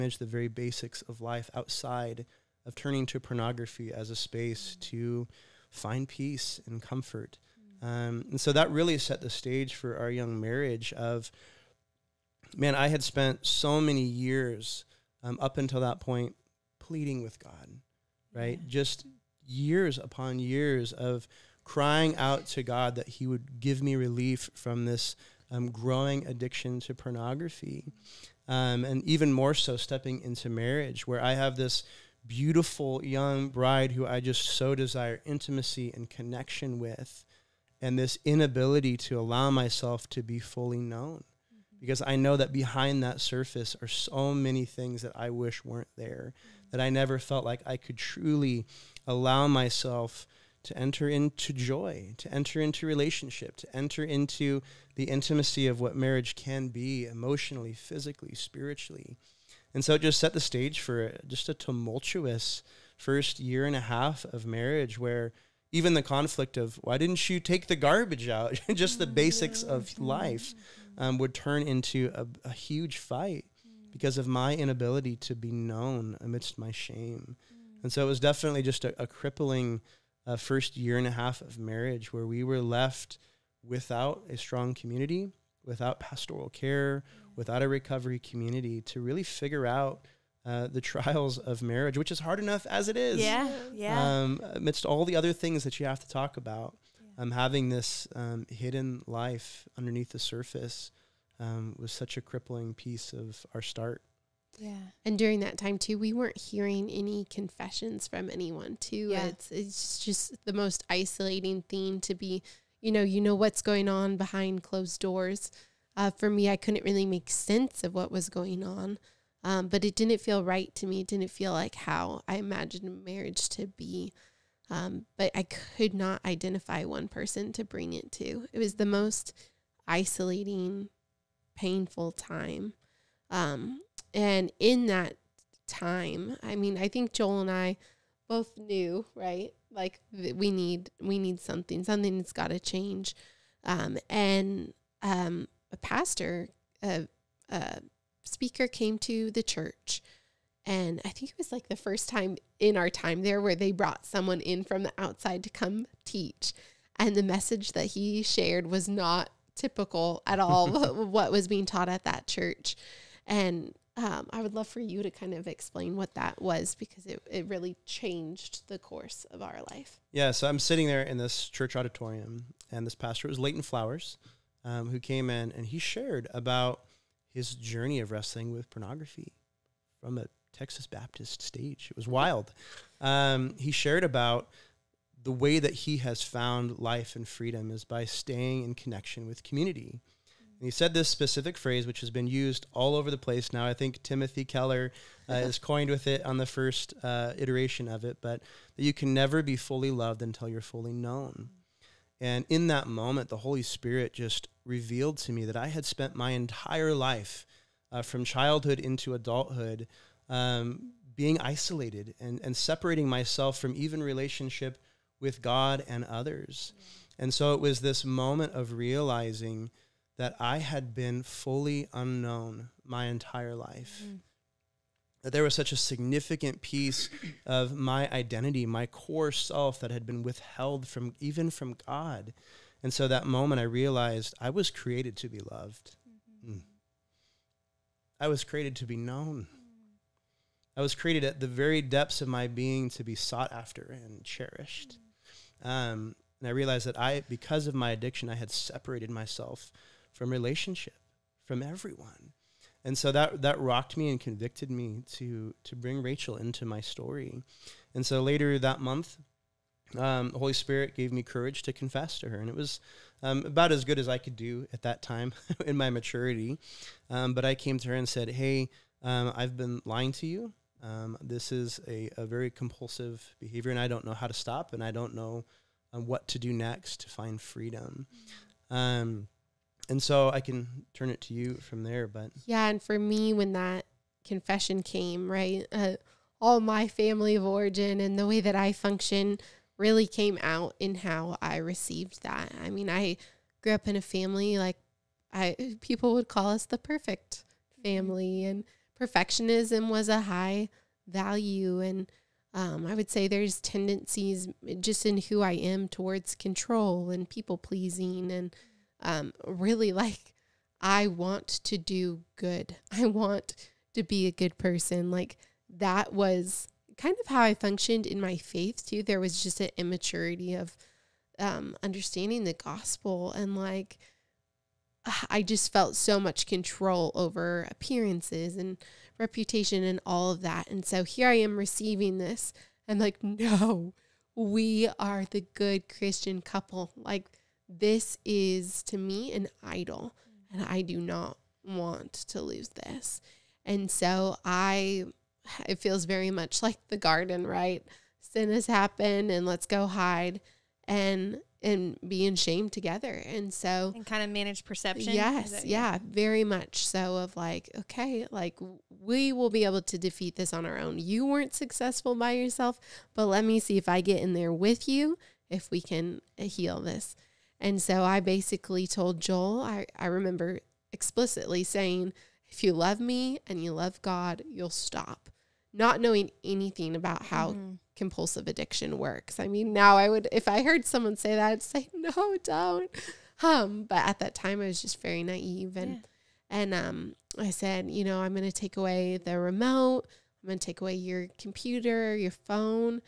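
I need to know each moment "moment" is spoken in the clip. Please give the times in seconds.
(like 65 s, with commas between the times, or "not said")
202 s, 218 s, 233 s.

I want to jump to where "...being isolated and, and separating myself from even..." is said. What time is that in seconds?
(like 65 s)
211 s.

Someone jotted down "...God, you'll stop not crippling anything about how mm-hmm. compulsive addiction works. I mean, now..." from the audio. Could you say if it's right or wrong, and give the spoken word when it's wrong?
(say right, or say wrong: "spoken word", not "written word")
wrong: "knowing", not "crippling".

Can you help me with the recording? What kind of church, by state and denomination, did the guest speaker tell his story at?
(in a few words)
Texas Baptist.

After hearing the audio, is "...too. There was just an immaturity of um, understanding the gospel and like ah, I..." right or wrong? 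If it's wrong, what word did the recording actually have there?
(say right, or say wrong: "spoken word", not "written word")
right.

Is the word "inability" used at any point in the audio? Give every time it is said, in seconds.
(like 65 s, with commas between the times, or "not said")
38 s, 74 s.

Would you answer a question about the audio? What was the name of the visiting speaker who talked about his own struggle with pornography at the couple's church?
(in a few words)
Leighton Flowers.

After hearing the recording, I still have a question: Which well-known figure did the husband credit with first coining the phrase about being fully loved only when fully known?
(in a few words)
Timothy Keller.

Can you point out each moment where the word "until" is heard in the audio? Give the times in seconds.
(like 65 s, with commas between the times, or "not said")
15 s, 200 s.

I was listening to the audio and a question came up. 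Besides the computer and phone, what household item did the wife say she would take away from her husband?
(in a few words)
The remote.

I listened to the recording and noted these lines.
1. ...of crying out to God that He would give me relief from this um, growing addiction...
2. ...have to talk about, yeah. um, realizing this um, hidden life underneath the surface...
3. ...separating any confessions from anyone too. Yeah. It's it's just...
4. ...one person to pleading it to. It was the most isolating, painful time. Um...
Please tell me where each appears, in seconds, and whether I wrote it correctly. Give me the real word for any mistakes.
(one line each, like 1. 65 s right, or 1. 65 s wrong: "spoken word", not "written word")
1. 20 s right
2. 95 s wrong: "having", not "realizing"
3. 106 s wrong: "hearing", not "separating"
4. 126 s wrong: "bring", not "pleading".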